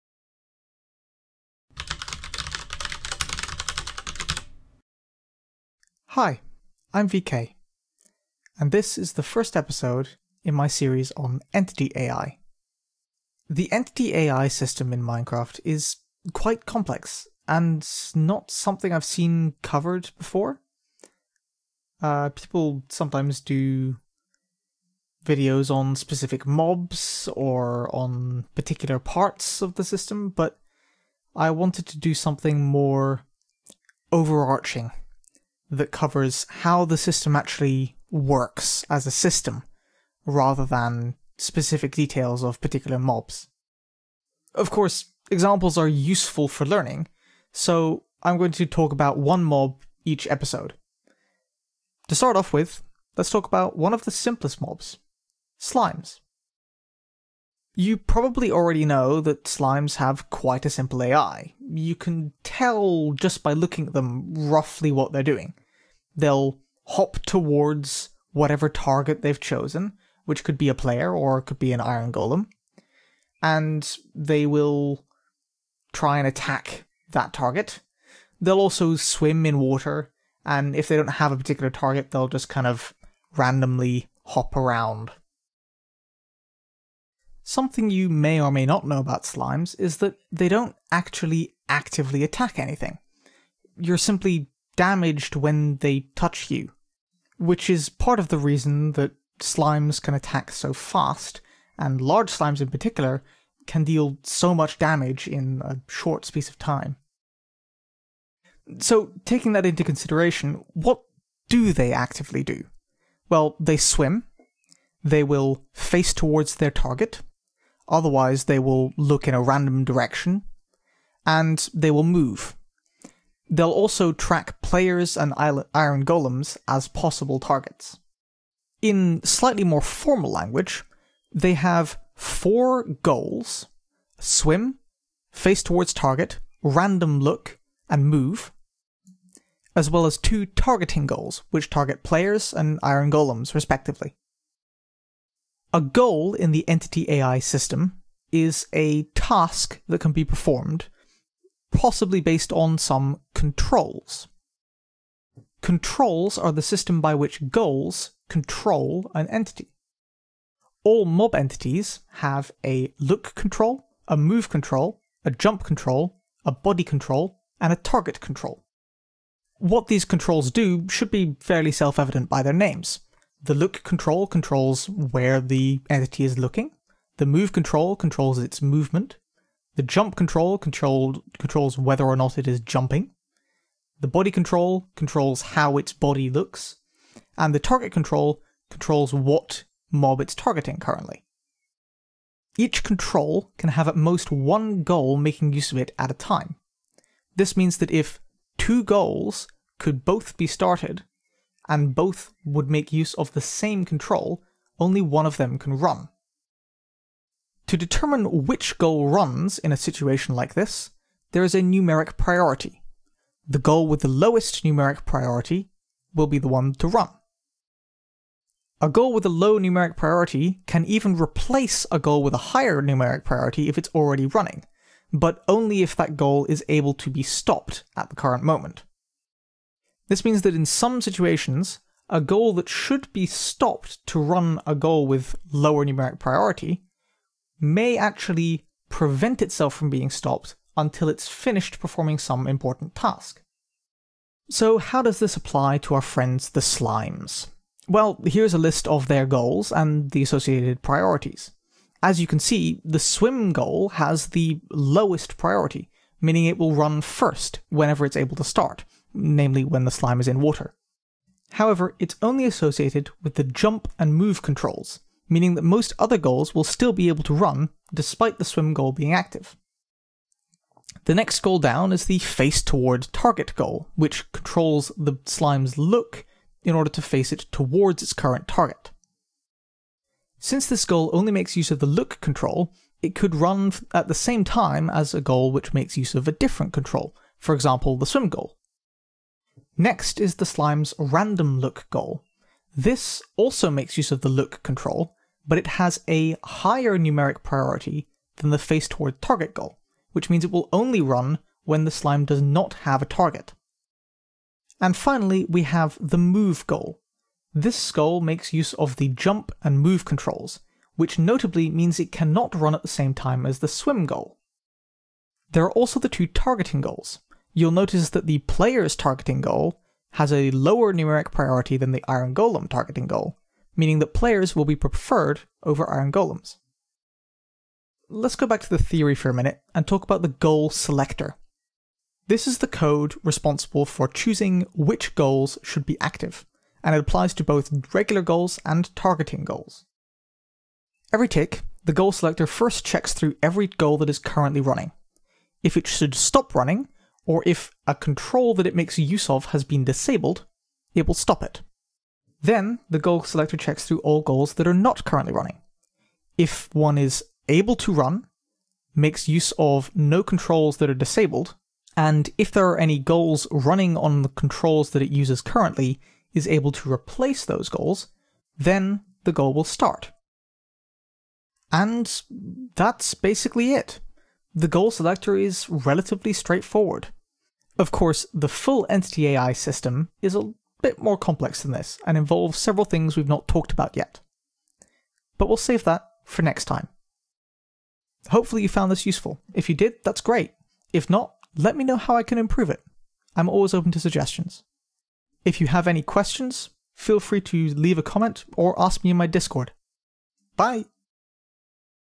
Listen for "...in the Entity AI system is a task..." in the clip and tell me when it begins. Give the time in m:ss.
2:26.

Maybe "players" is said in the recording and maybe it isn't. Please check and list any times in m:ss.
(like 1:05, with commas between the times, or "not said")
1:10, 2:04, 2:22, 5:18, 5:24.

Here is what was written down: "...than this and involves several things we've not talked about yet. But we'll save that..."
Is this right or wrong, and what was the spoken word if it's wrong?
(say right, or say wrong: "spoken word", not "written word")
right.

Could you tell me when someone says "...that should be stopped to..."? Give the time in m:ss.
3:52.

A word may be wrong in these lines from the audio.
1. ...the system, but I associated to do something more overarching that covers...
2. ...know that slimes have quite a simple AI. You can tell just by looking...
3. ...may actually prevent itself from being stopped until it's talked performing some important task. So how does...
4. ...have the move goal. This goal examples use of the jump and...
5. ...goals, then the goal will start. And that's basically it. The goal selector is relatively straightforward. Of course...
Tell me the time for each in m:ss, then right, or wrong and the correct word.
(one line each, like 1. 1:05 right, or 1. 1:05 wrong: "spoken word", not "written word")
1. 0:29 wrong: "wanted", not "associated"
2. 0:58 right
3. 3:57 wrong: "finished", not "talked"
4. 5:05 wrong: "makes", not "examples"
5. 6:07 right.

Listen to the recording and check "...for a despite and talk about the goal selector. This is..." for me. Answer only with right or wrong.
wrong.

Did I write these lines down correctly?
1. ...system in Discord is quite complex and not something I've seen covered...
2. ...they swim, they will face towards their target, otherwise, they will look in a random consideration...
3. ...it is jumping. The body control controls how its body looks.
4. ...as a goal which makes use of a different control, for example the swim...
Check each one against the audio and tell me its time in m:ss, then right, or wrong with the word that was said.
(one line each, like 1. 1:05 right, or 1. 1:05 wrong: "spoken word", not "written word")
1. 0:14 wrong: "Minecraft", not "Discord"
2. 1:53 wrong: "direction", not "consideration"
3. 3:02 right
4. 4:44 right.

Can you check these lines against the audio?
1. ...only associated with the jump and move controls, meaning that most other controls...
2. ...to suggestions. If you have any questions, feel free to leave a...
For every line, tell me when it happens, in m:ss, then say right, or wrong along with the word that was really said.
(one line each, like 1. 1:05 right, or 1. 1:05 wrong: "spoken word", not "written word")
1. 4:22 wrong: "goals", not "controls"
2. 6:33 right.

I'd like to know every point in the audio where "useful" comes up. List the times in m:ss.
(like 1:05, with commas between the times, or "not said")
0:45, 6:29.